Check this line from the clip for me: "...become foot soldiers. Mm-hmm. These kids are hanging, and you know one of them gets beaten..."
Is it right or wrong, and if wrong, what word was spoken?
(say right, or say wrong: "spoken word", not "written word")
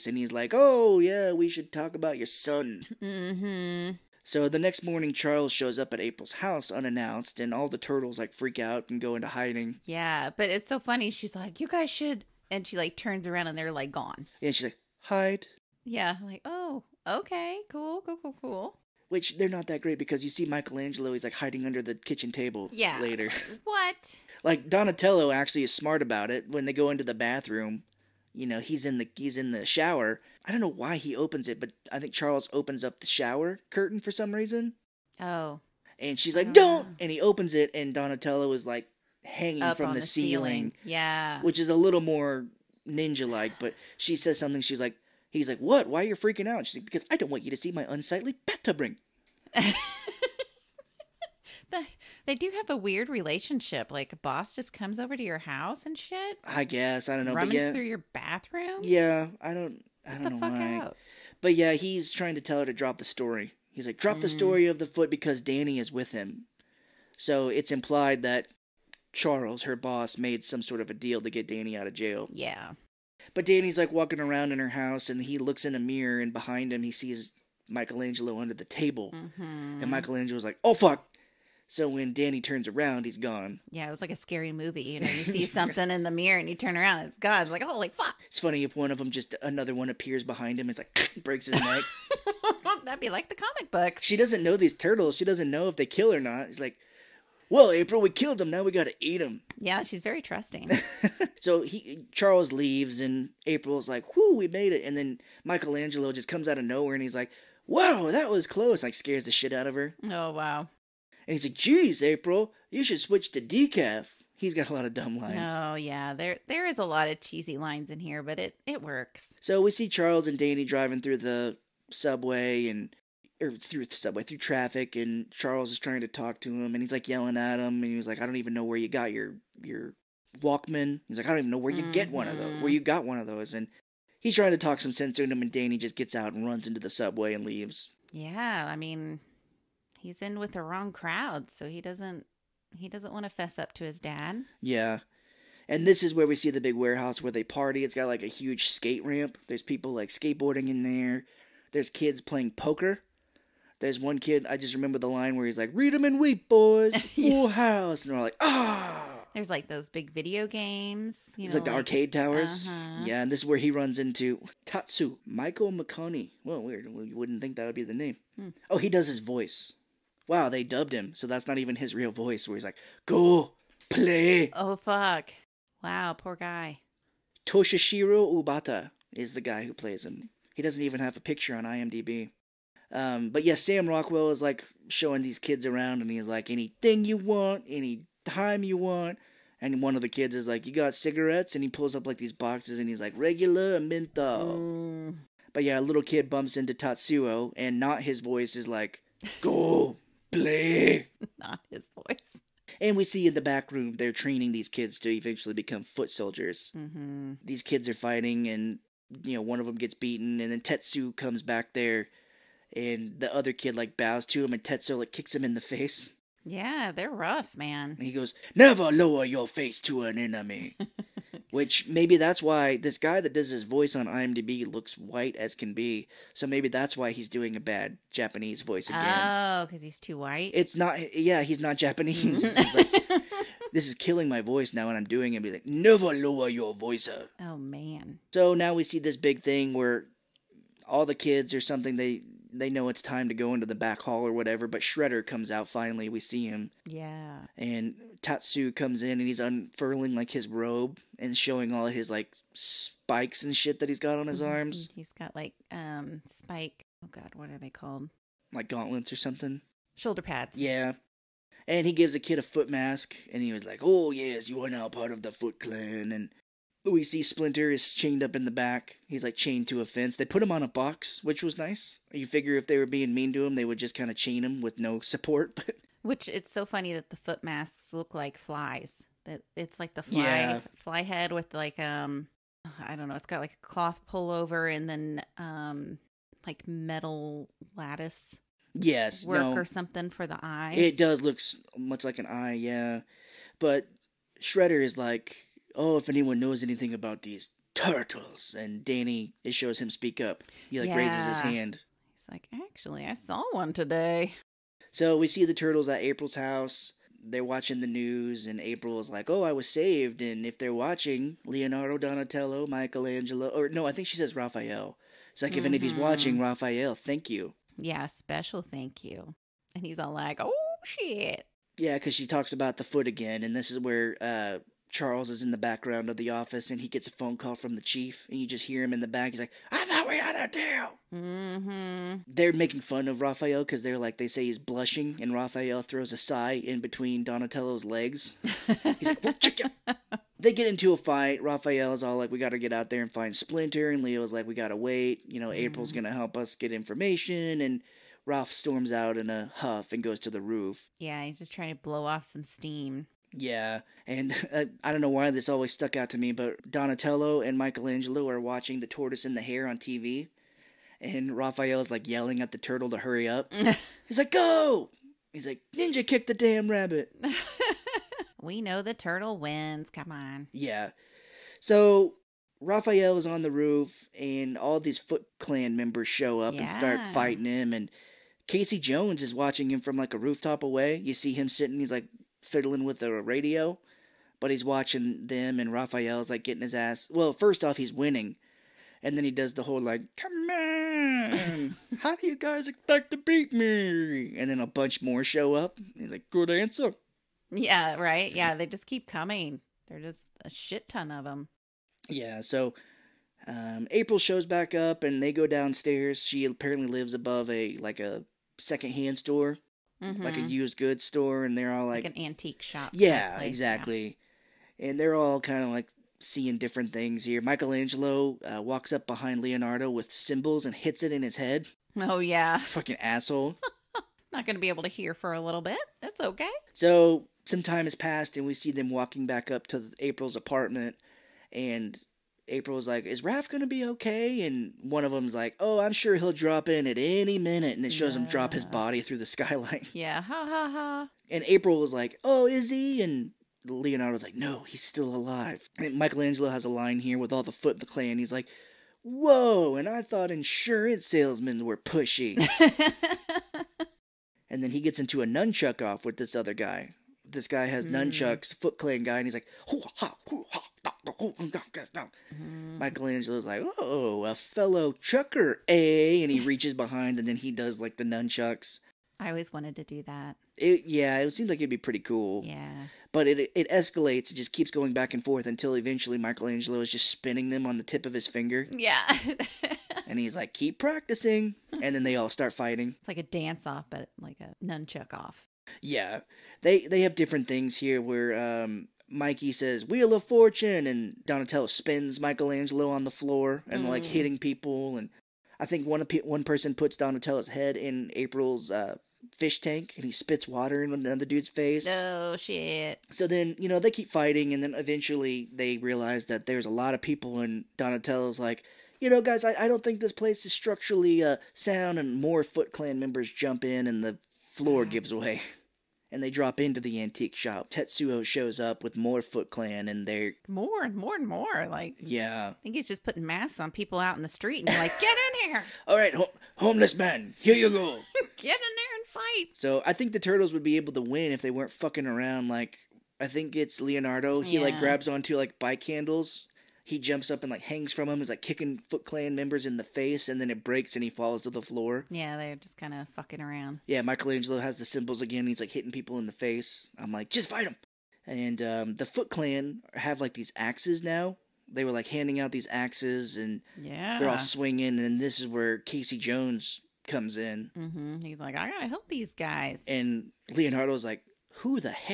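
wrong: "fighting", not "hanging".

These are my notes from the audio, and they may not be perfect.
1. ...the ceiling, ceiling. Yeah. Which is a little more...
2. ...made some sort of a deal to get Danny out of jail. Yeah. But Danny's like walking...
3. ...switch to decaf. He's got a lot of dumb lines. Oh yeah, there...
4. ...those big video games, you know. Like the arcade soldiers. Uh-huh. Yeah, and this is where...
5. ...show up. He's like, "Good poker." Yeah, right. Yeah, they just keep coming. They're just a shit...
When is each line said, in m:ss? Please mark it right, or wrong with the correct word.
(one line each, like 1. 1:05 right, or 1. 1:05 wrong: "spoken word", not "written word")
1. 0:40 right
2. 1:10 right
3. 1:52 right
4. 2:39 wrong: "towers", not "soldiers"
5. 6:35 wrong: "answer", not "poker".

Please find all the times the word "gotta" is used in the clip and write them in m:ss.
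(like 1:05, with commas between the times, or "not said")
1:38, 9:18.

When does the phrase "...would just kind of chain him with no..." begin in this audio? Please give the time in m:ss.
4:33.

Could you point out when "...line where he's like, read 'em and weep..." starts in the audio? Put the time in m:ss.
2:35.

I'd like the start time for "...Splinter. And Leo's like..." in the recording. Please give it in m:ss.
5:43.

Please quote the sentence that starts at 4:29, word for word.
He's like chained to a fence.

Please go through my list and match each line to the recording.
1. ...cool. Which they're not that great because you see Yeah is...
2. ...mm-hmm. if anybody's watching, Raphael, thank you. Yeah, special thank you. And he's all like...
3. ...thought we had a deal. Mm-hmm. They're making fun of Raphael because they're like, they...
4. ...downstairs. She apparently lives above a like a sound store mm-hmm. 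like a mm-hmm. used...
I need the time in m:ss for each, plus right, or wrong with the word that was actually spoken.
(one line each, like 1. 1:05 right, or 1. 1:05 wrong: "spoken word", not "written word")
1. 0:18 wrong: "Michelangelo", not "Yeah"
2. 5:15 right
3. 5:29 right
4. 6:45 wrong: "secondhand", not "sound".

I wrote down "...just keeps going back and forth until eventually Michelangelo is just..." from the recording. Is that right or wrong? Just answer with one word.
right.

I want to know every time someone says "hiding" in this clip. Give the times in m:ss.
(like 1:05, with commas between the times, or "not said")
0:09, 0:21.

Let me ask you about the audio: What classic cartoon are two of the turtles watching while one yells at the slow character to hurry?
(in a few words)
The Tortoise and the Hare.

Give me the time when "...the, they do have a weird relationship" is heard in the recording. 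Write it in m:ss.
0:51.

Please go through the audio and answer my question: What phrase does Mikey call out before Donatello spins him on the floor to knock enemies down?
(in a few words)
Wheel of Fortune.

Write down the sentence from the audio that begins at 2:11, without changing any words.
get one of those, where mm-hmm.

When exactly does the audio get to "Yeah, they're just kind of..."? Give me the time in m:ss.
9:02.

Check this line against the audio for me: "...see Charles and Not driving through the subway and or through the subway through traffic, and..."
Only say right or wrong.
wrong.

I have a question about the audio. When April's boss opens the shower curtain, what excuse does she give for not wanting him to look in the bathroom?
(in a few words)
Unsightly bathtub ring.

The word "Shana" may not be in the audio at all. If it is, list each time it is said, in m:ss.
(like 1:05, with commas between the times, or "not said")
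not said.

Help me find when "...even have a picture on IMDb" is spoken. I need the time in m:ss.
3:00.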